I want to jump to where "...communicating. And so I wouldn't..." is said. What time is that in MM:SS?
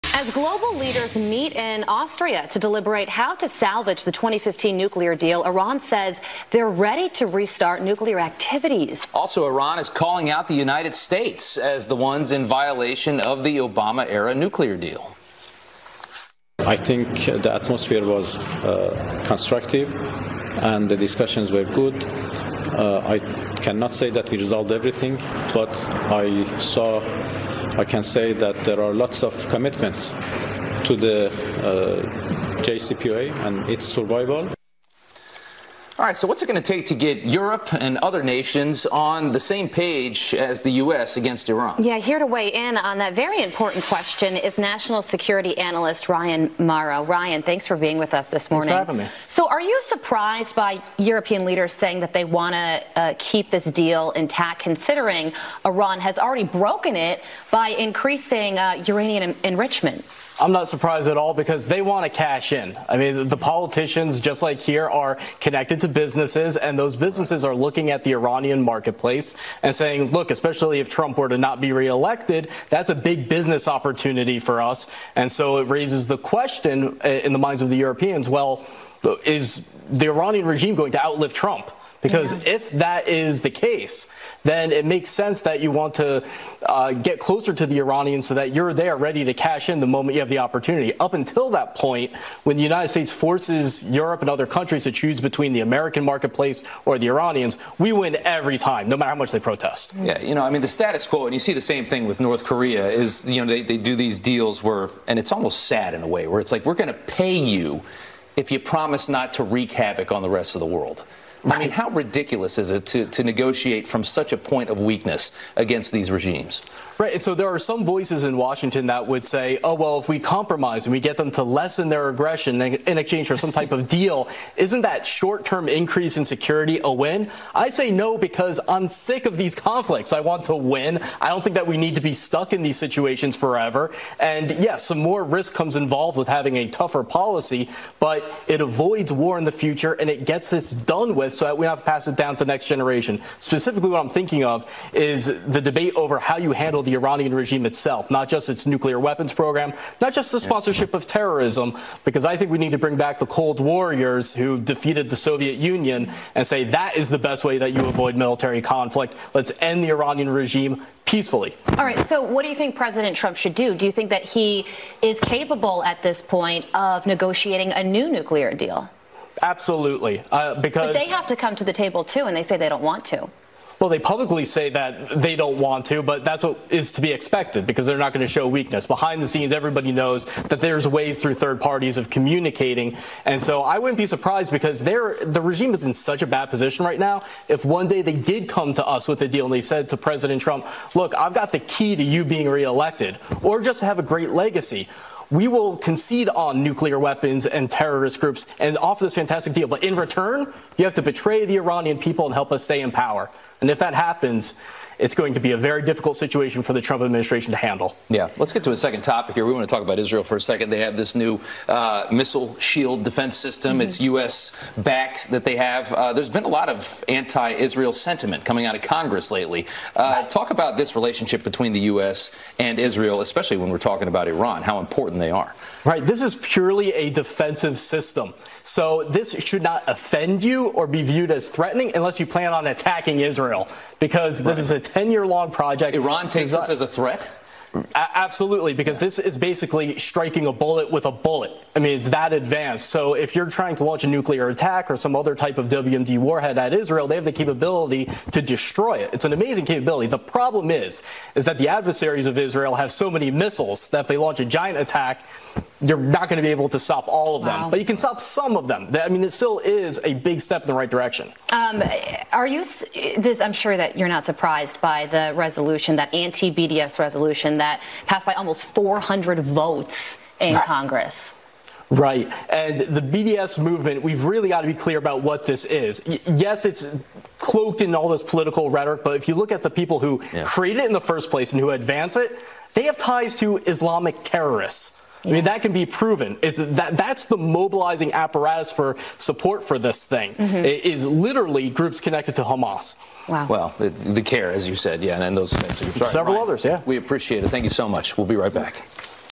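03:02.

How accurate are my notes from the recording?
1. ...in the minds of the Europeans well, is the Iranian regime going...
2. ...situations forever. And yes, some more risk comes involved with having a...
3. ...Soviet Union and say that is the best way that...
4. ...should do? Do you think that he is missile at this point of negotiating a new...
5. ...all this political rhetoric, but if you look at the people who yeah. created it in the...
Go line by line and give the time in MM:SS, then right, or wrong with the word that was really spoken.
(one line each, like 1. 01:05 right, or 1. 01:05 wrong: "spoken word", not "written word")
1. 01:17 right
2. 02:12 right
3. 02:35 right
4. 02:43 wrong: "capable", not "missile"
5. 04:37 right.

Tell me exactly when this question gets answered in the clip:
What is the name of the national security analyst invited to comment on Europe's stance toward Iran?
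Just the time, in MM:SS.
00:46.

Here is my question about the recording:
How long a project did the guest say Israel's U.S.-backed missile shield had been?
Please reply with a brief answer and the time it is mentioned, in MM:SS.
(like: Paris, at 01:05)
10 years, at 03:54.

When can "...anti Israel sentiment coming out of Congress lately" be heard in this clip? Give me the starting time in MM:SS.
03:37.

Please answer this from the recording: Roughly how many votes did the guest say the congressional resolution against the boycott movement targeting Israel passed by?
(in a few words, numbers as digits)
almost 400.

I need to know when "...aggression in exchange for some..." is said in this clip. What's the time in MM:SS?
02:02.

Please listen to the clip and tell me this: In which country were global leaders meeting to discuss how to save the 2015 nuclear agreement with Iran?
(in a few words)
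Austria.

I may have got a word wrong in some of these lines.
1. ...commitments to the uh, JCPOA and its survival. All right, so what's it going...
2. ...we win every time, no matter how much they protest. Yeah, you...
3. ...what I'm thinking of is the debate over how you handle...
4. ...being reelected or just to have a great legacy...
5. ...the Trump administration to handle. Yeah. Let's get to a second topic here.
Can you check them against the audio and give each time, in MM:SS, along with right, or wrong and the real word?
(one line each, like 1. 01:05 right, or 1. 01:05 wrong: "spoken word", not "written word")
1. 00:29 right
2. 01:37 right
3. 02:23 right
4. 03:12 right
5. 03:26 right.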